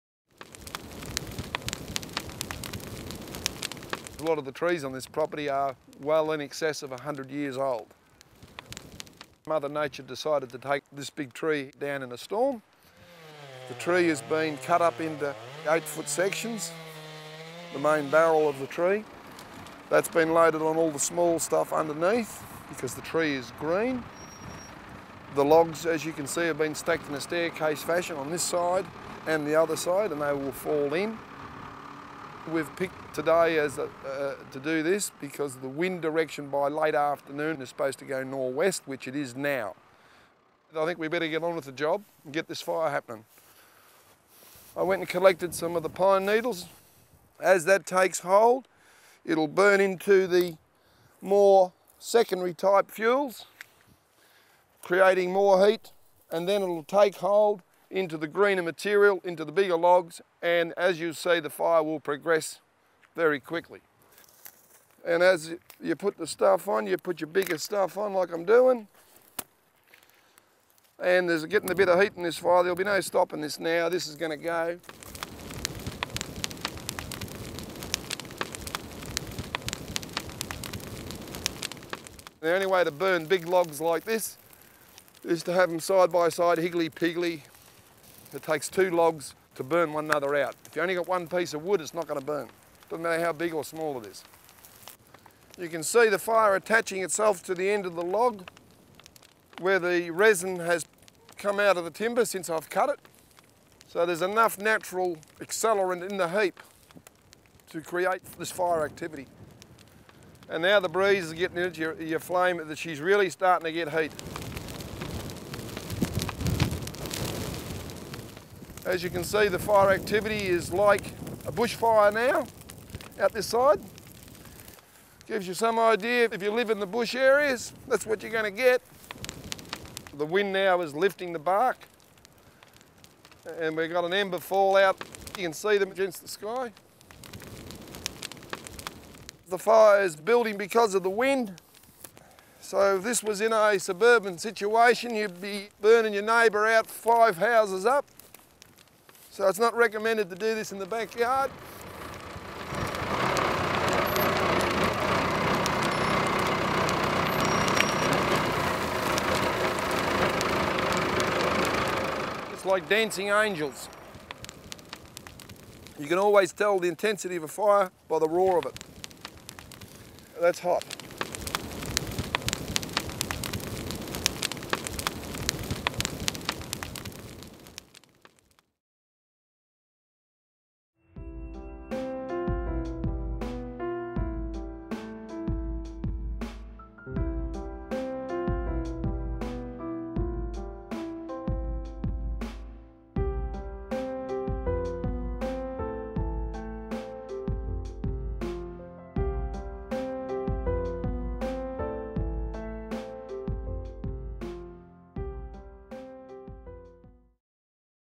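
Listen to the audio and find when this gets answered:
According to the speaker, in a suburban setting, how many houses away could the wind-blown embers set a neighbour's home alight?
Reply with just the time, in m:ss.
2:26.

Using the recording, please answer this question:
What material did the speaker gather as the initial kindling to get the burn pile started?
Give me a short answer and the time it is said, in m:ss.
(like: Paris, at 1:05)
Pine needles, at 0:45.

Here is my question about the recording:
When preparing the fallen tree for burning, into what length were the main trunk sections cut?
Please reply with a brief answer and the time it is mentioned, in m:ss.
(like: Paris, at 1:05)
8 feet, at 0:15.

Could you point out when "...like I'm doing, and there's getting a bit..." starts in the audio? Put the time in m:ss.
1:08.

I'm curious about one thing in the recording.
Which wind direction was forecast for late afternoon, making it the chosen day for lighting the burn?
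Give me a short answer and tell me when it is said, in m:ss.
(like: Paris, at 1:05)
Northwest, at 0:38.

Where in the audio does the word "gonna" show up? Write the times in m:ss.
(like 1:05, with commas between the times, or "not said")
1:14, 2:08.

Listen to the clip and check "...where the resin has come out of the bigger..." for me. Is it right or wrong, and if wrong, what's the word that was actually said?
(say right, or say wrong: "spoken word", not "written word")
wrong: "timber", not "bigger".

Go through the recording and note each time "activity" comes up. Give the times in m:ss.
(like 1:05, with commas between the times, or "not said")
1:48, 1:59.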